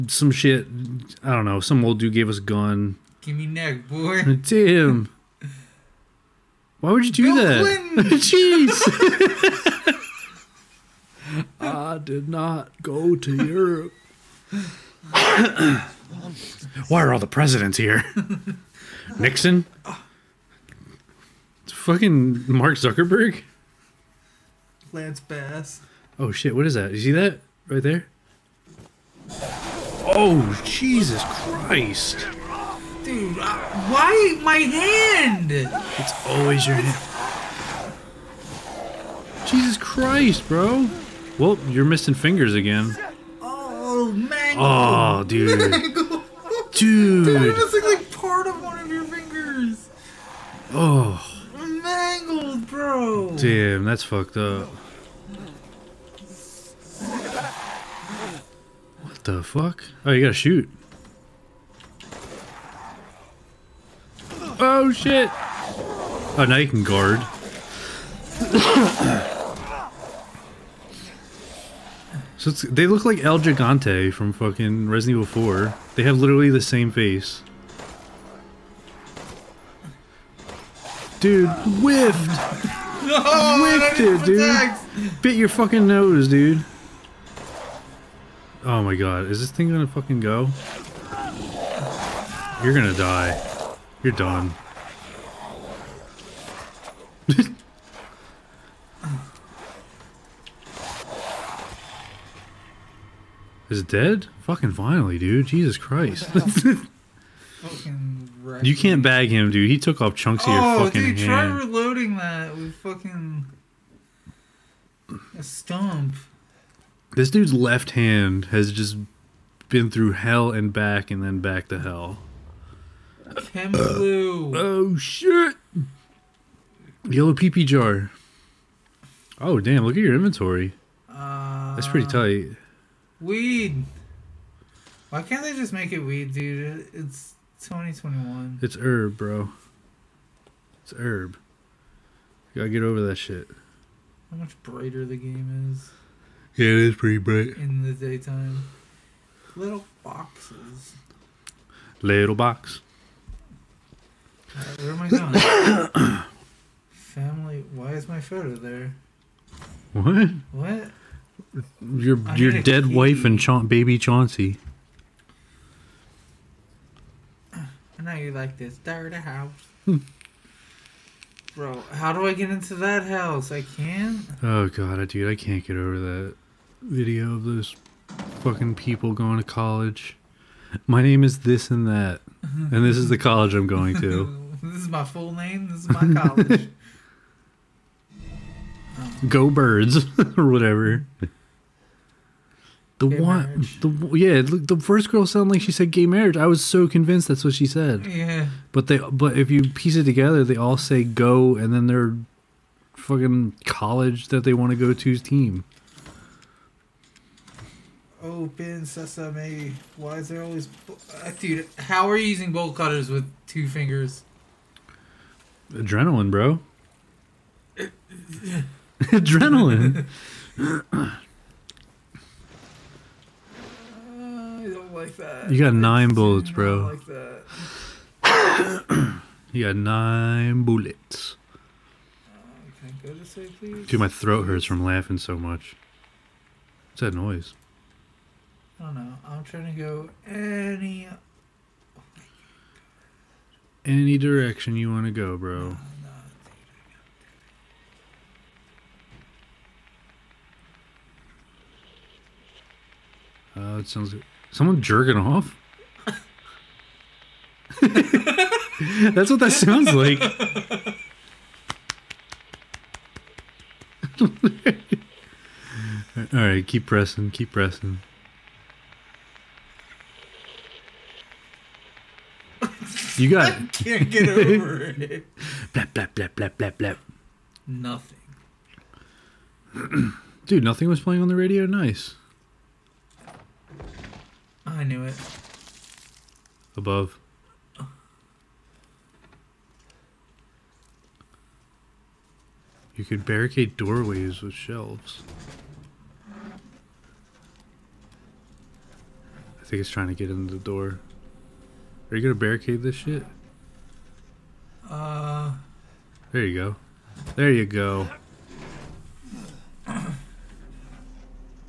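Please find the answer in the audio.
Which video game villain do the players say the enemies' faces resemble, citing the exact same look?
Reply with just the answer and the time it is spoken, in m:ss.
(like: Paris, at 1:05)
El Gigante, at 1:13.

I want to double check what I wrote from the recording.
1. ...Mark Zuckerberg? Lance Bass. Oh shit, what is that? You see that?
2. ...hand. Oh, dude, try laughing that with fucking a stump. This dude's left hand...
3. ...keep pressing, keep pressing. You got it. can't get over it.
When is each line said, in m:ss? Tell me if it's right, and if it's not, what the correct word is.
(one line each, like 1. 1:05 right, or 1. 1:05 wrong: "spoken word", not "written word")
1. 0:22 right
2. 1:51 wrong: "reloading", not "laughing"
3. 4:26 right.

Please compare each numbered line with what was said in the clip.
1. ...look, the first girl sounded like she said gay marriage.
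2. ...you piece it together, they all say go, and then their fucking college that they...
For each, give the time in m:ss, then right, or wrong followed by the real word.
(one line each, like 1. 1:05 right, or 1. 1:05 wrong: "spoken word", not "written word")
1. 3:14 right
2. 3:19 right.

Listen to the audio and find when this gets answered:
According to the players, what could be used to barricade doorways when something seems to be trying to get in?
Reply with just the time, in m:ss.
4:54.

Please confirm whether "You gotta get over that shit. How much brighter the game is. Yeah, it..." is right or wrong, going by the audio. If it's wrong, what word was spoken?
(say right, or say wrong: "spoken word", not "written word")
right.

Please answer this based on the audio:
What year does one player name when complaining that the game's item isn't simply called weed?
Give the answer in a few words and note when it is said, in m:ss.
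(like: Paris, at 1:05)
2021, at 2:17.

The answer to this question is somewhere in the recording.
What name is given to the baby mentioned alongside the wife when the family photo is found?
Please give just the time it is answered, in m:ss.
2:43.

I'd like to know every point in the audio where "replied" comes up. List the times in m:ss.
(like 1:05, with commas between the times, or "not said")
not said.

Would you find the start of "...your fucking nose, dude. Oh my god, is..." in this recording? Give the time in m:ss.
1:25.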